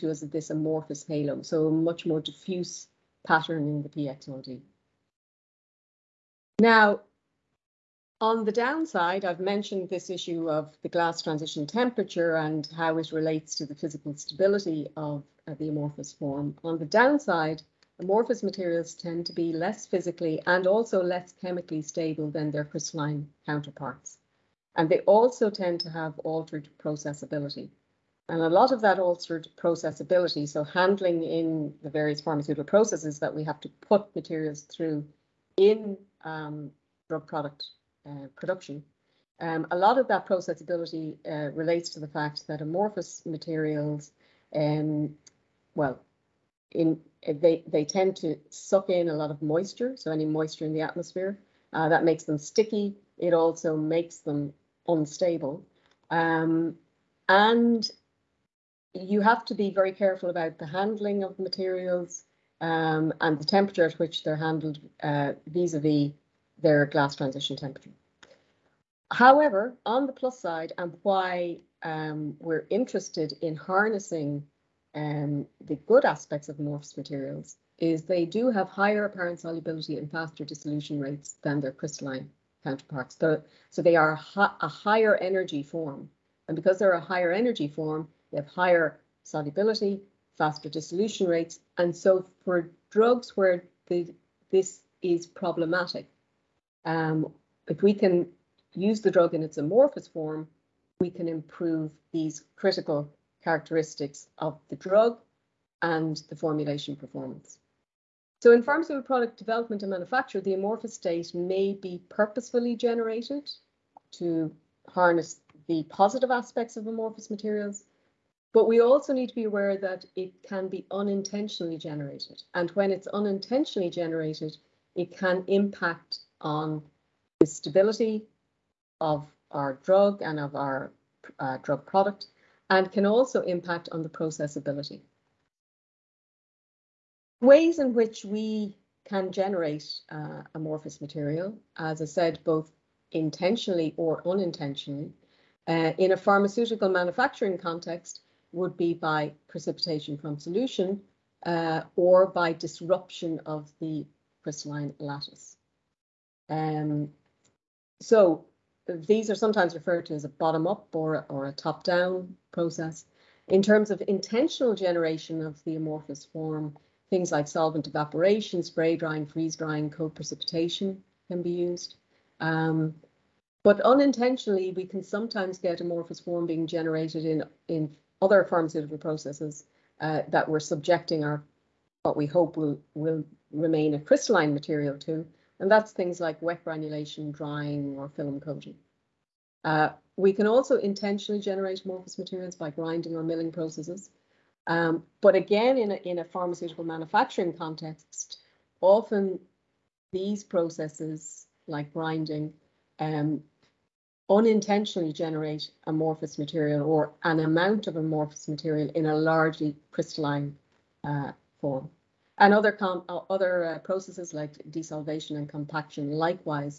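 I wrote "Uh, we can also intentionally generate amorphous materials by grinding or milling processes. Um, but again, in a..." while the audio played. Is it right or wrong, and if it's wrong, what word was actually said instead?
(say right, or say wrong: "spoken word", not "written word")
right.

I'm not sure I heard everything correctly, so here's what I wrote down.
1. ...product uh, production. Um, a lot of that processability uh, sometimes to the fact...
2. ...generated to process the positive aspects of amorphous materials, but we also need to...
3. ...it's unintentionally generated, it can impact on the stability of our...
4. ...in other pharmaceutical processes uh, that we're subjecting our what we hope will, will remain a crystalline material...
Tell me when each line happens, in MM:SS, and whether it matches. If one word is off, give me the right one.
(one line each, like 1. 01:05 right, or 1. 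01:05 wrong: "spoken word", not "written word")
1. 00:37 wrong: "relates", not "sometimes"
2. 01:52 wrong: "harness", not "process"
3. 02:02 right
4. 02:57 right.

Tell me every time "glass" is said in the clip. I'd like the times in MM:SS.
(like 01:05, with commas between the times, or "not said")
00:10, 01:06.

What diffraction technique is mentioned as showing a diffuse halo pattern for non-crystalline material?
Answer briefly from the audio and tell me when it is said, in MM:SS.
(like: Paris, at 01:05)
PXRD, at 00:03.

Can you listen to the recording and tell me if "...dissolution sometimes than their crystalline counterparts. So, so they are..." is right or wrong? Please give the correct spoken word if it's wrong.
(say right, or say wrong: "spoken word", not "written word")
wrong: "rates", not "sometimes".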